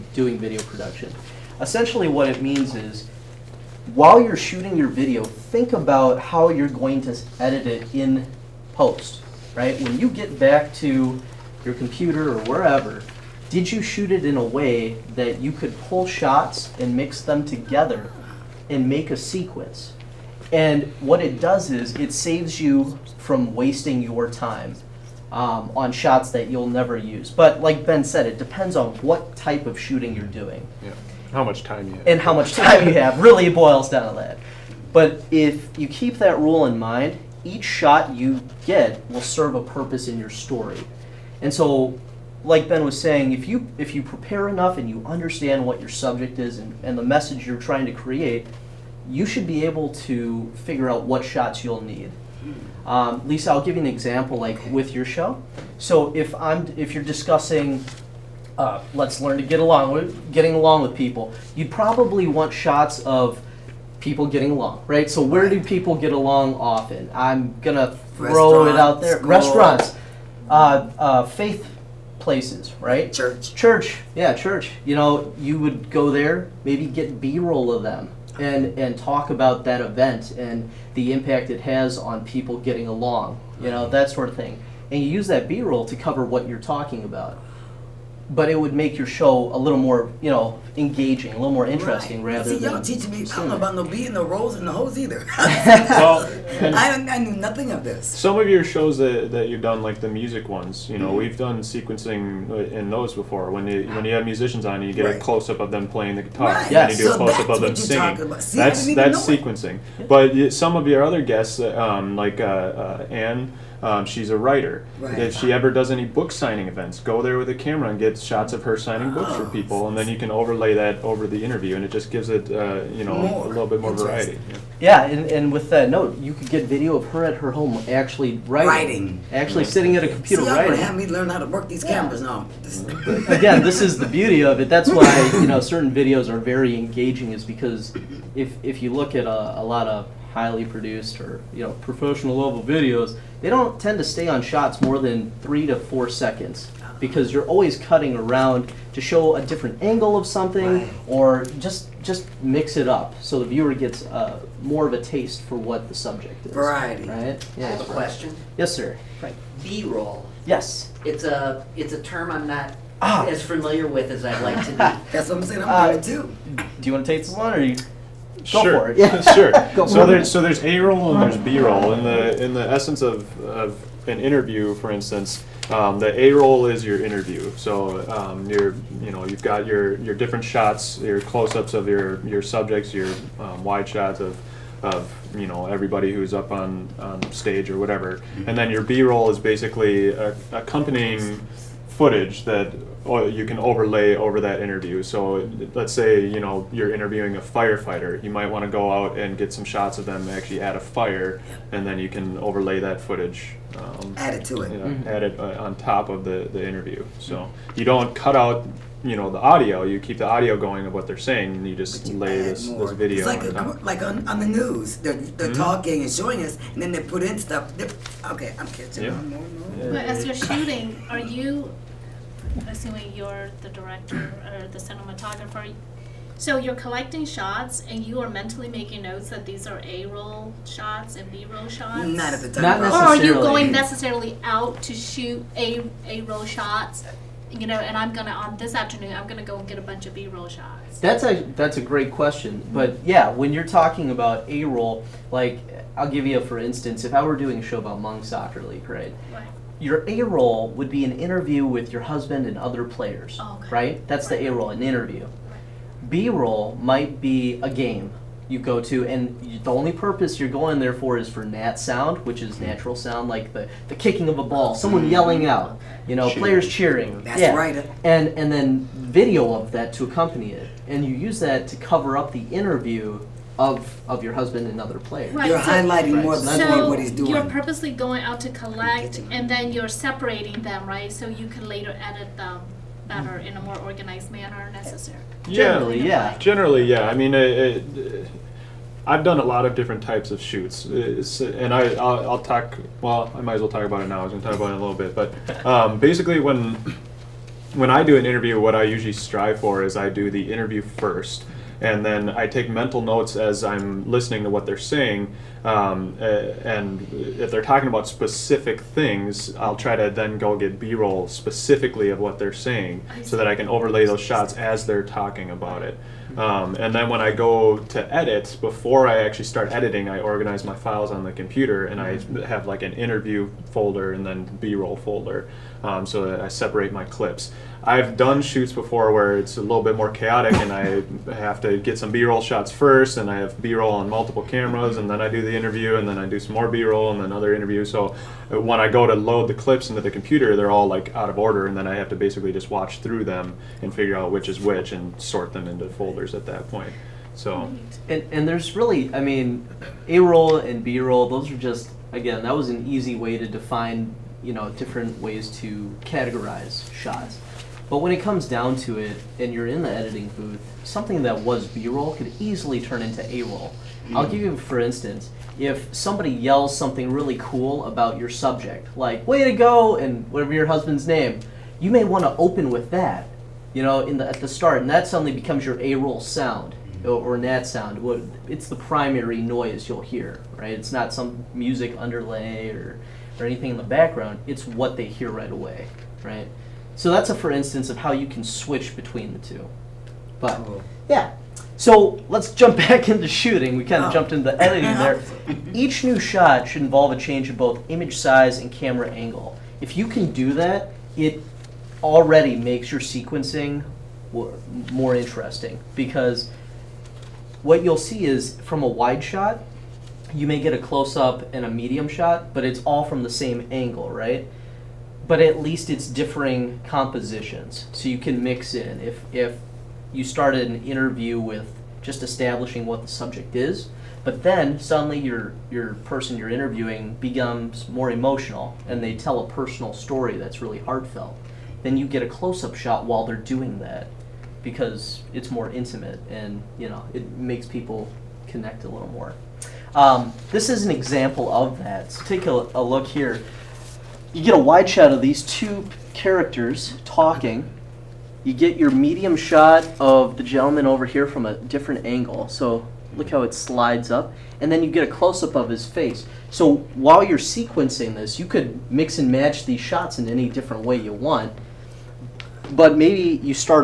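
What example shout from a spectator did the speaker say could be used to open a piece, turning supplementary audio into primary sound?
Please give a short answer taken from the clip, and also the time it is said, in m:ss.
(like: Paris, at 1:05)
Way to go!, at 6:09.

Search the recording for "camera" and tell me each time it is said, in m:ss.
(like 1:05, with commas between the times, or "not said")
1:57, 2:11, 5:34, 6:38.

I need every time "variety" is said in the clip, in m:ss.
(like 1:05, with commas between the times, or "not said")
2:03, 2:36.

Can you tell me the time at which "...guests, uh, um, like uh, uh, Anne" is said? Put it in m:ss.
1:51.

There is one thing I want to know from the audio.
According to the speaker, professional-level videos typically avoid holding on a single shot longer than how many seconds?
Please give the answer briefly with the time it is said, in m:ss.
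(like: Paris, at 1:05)
3 to 4 seconds, at 2:25.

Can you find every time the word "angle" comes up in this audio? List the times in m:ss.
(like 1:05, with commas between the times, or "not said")
2:29, 6:39, 6:53, 7:32.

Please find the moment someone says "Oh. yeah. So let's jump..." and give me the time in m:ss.
6:30.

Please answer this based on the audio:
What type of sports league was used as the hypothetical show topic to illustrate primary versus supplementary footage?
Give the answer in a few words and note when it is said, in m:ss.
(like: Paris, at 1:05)
monk soccer league, at 4:07.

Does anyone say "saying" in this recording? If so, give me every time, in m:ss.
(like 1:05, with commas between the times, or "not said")
0:42, 2:45, 3:31, 5:04, 5:12.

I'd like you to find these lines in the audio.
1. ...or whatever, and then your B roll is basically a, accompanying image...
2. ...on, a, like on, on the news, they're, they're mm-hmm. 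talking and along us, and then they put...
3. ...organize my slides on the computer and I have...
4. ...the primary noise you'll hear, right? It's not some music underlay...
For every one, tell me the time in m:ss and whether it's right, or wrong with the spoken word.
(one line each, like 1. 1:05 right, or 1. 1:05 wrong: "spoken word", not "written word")
1. 3:07 wrong: "footage", not "image"
2. 3:33 wrong: "showing", not "along"
3. 5:20 wrong: "files", not "slides"
4. 6:18 right.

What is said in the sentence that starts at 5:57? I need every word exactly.
But when it comes down to it, and you're in the editing booth, something that was B-roll could easily turn into A-roll.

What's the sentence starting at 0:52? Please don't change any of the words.
Um, Lisa, I'll give you an example, like with your show.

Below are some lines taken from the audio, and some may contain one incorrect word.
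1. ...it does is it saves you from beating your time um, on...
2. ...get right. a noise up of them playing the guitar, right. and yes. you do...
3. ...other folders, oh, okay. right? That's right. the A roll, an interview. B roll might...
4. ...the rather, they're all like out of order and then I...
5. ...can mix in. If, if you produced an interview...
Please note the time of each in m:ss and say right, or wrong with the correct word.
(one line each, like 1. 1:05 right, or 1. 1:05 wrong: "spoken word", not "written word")
1. 0:21 wrong: "wasting", not "beating"
2. 1:44 wrong: "close", not "noise"
3. 4:12 wrong: "players", not "folders"
4. 5:40 wrong: "computer", not "rather"
5. 6:58 wrong: "started", not "produced".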